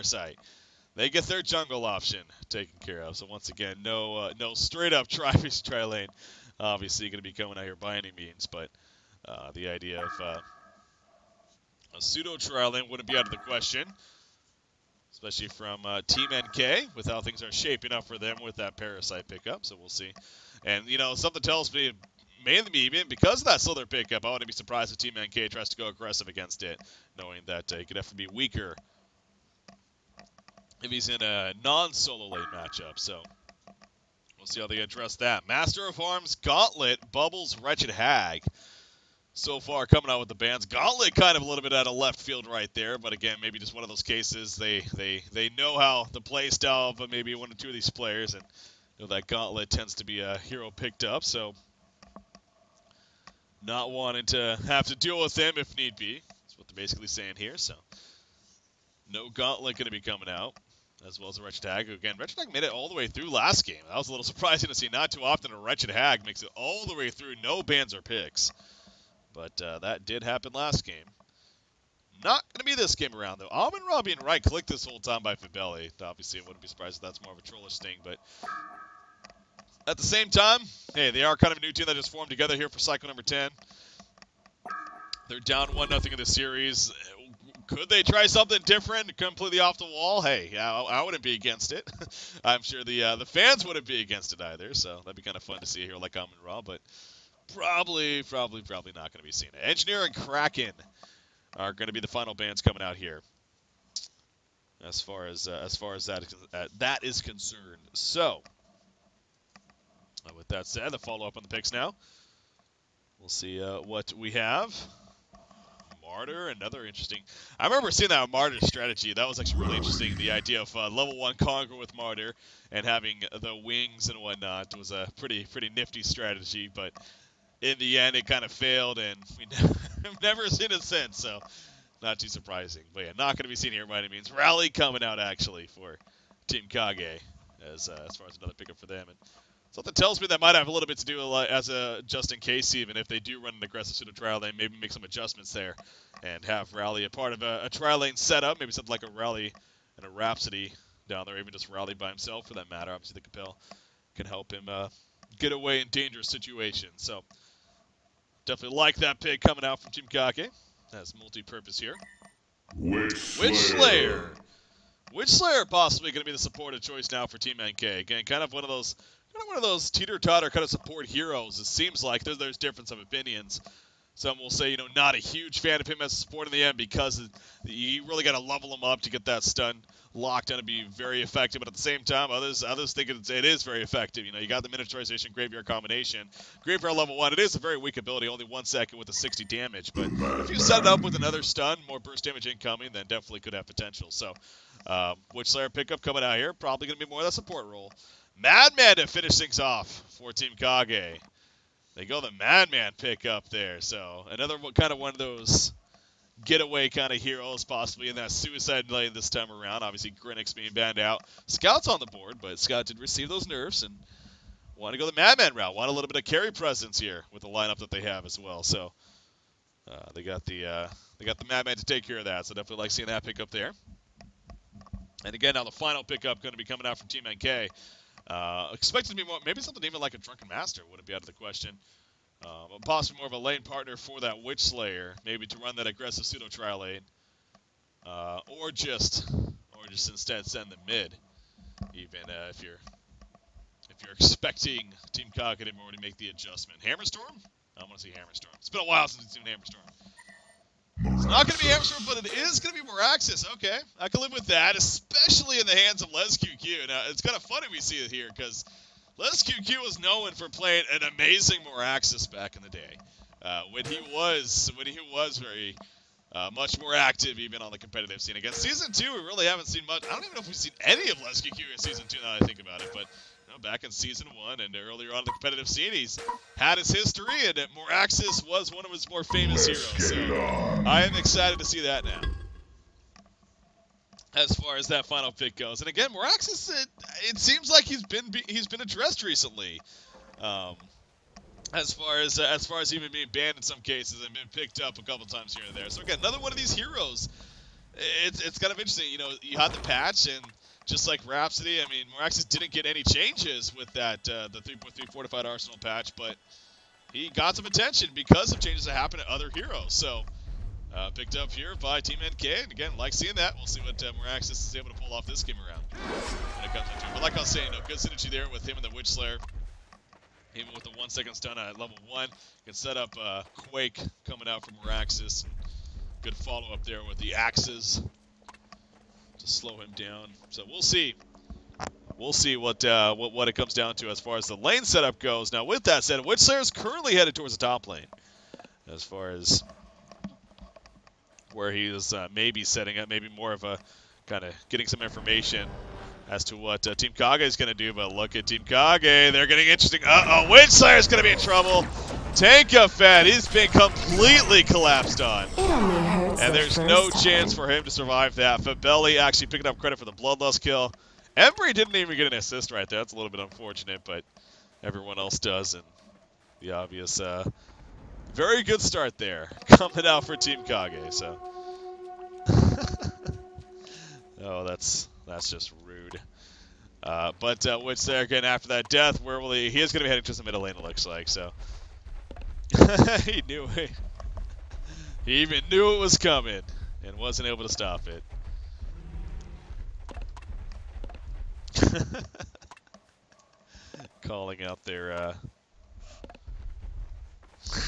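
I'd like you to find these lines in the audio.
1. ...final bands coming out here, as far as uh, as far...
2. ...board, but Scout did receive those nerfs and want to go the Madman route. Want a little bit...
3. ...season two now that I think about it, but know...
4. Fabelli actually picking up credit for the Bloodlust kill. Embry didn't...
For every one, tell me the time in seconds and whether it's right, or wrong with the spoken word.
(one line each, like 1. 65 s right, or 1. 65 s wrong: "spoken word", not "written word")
1. 102 s right
2. 212 s right
3. 271 s right
4. 358 s right.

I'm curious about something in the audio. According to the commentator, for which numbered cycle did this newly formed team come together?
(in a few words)
10.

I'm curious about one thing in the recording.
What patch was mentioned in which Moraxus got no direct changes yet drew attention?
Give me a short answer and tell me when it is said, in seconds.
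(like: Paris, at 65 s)
fortified arsenal, at 305 s.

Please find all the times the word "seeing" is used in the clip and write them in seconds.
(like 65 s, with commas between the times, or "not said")
117 s, 222 s, 313 s.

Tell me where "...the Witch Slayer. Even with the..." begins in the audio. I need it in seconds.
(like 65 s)
318 s.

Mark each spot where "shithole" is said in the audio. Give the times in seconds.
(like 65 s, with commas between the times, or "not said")
not said.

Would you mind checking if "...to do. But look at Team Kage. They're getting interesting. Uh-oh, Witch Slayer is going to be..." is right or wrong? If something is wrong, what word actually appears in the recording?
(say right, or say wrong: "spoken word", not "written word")
right.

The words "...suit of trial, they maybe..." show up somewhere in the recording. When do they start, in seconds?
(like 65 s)
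143 s.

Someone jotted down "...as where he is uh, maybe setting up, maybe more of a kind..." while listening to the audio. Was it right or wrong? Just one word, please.
right.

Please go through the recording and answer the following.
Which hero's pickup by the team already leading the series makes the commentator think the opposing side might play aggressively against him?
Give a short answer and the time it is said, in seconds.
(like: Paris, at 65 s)
Slither, at 23 s.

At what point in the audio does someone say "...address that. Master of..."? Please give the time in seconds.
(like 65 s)
34 s.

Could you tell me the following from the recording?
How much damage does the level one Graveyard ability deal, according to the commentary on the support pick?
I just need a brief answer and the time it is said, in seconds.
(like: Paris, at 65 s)
60, at 189 s.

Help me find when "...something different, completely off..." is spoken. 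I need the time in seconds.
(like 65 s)
88 s.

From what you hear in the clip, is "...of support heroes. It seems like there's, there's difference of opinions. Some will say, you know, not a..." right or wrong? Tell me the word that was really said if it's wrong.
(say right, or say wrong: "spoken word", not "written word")
right.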